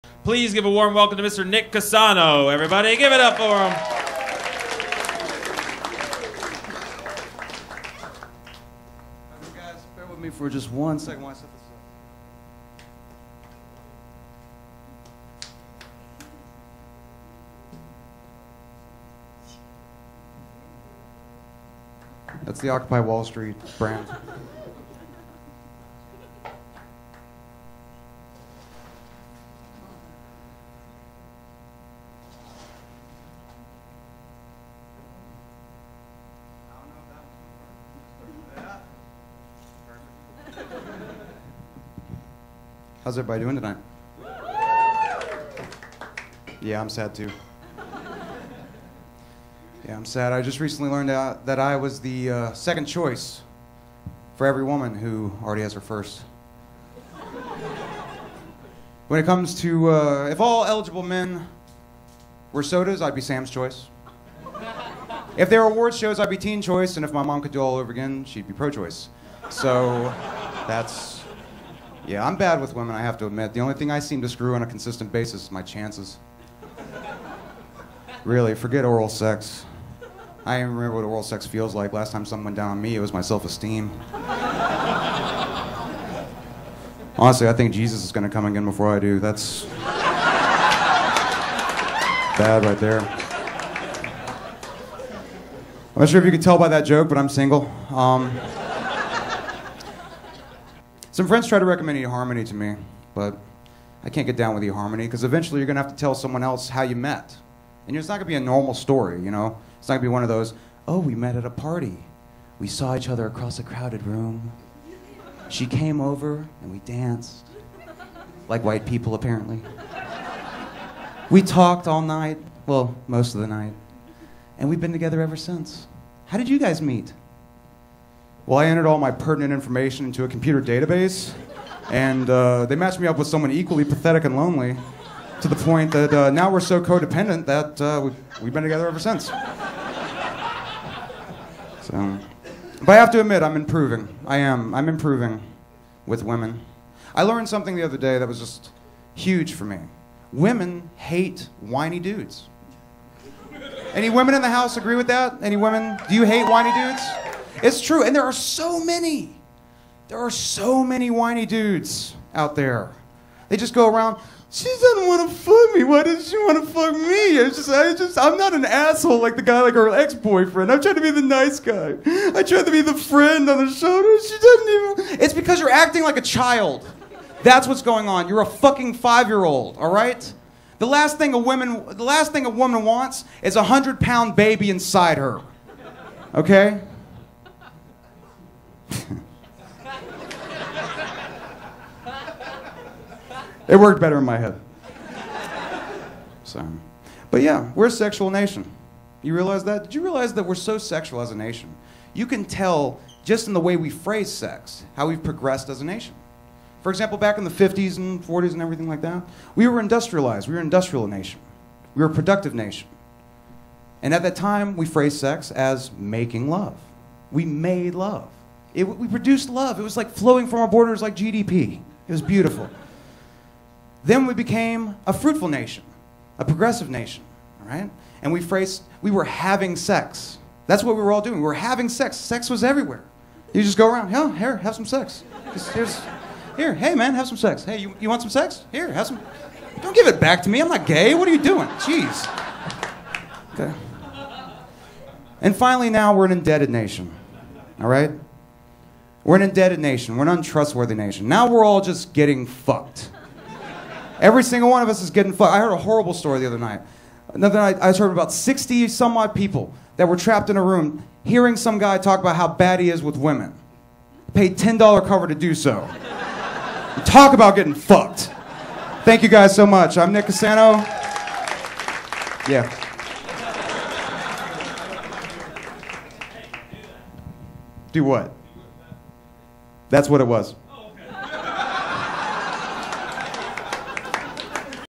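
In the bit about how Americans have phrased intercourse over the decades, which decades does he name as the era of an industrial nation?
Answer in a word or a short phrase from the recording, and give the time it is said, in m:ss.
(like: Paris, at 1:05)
50s and 40s, at 3:27.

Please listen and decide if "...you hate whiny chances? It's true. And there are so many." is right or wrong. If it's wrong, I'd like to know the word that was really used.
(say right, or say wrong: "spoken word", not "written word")
wrong: "dudes", not "chances".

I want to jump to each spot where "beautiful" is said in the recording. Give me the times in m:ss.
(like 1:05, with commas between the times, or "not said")
3:42.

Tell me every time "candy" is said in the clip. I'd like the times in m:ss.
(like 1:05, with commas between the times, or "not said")
not said.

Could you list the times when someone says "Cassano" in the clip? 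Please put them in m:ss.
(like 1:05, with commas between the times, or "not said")
0:01, 4:30.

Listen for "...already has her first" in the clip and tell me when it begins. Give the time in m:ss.
0:55.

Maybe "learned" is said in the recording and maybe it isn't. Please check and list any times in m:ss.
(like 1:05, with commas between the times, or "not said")
0:50, 2:27.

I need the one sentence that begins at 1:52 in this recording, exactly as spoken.
We saw each other across a crowded room.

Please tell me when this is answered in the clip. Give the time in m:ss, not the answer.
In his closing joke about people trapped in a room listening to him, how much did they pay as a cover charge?
4:24.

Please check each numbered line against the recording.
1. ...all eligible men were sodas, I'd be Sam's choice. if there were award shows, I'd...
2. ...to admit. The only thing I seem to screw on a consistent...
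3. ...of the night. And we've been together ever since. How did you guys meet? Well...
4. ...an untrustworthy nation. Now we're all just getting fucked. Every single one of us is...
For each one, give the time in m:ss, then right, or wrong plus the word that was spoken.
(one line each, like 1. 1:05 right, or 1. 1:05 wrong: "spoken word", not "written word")
1. 1:00 right
2. 1:13 right
3. 2:03 right
4. 4:10 right.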